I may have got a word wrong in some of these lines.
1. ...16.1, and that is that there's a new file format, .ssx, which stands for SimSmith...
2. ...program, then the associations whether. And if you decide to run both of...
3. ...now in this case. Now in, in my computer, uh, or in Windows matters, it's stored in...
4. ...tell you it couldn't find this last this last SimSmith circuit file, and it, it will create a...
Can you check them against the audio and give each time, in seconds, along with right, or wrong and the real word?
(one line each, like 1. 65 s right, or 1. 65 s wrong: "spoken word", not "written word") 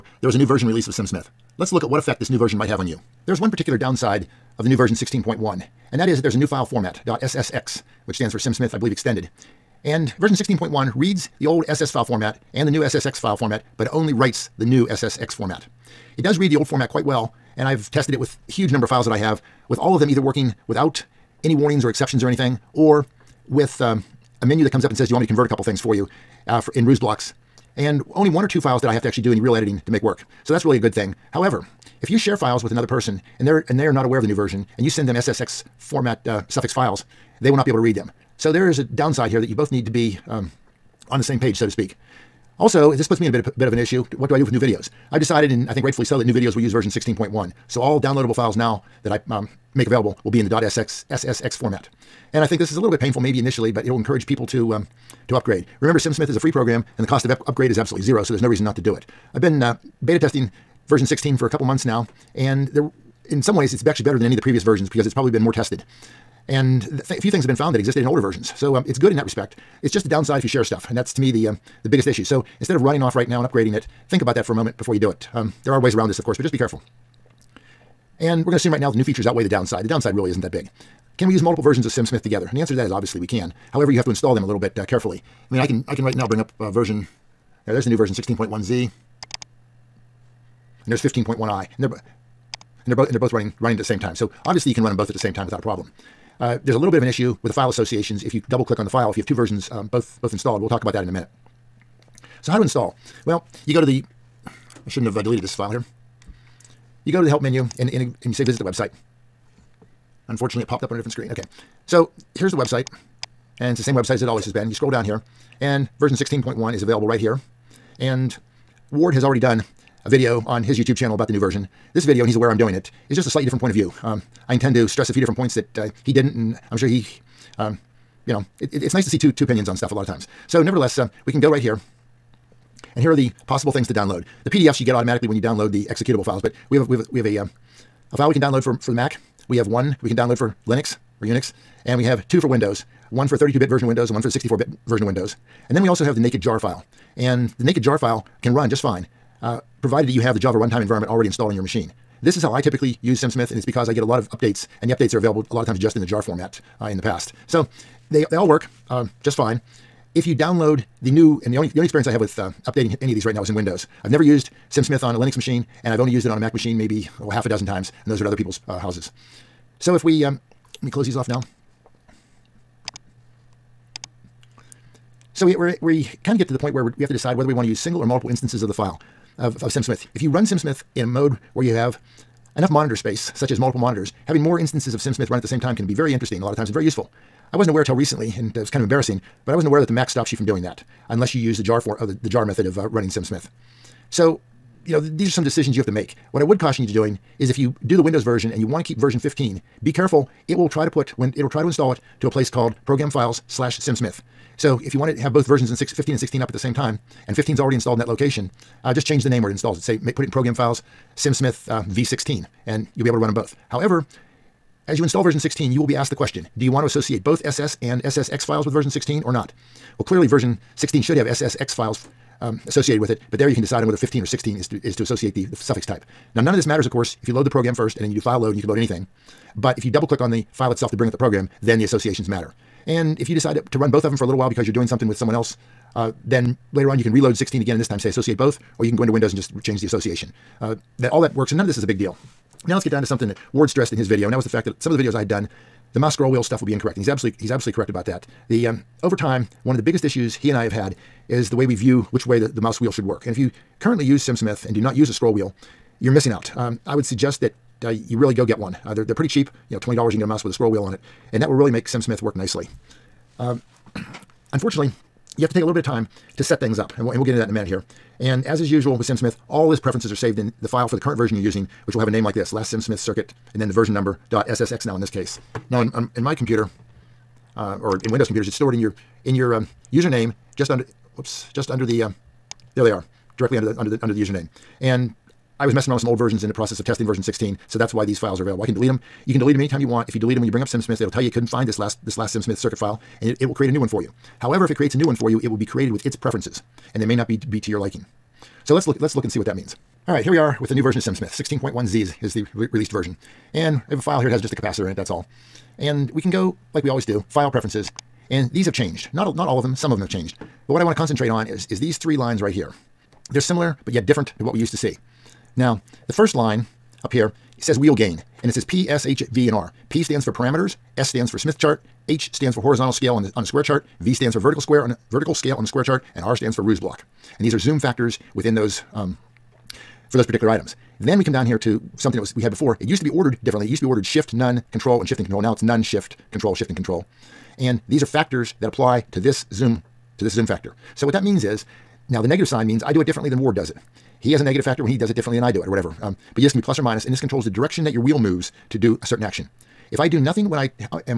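1. 4 s right
2. 231 s wrong: "matter", not "whether"
3. 274 s wrong: "computers", not "matters"
4. 291 s right.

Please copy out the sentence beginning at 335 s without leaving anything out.
Now it's none, shift, control, shift and control.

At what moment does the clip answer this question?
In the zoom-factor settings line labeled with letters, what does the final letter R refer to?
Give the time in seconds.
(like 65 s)
326 s.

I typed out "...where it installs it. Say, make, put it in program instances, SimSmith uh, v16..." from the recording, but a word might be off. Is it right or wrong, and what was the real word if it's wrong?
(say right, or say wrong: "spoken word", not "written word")
wrong: "files", not "instances".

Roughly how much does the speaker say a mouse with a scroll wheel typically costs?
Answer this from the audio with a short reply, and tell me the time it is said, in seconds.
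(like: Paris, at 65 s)
$20, at 259 s.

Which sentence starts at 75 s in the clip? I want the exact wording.
Um, there are ways around this, of course, but just be careful.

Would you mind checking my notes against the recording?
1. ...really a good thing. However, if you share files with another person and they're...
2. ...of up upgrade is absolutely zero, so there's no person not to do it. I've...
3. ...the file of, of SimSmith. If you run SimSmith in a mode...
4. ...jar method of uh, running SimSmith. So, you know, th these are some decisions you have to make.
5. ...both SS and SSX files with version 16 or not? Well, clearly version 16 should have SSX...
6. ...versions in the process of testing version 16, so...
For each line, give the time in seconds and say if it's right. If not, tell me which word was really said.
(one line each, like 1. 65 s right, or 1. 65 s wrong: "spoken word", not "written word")
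1. 30 s right
2. 57 s wrong: "reason", not "person"
3. 178 s right
4. 192 s right
5. 217 s right
6. 286 s right.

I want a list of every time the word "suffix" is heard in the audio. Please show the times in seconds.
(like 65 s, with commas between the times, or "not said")
36 s, 225 s.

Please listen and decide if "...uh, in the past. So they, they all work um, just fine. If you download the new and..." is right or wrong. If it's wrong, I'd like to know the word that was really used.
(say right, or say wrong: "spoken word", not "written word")
right.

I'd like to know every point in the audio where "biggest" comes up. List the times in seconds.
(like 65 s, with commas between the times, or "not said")
71 s, 249 s.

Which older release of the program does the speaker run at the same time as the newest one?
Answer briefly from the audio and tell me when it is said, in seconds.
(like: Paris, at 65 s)
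15.1i, at 91 s.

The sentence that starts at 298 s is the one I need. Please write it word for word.
So let's look, let's look and see what that means.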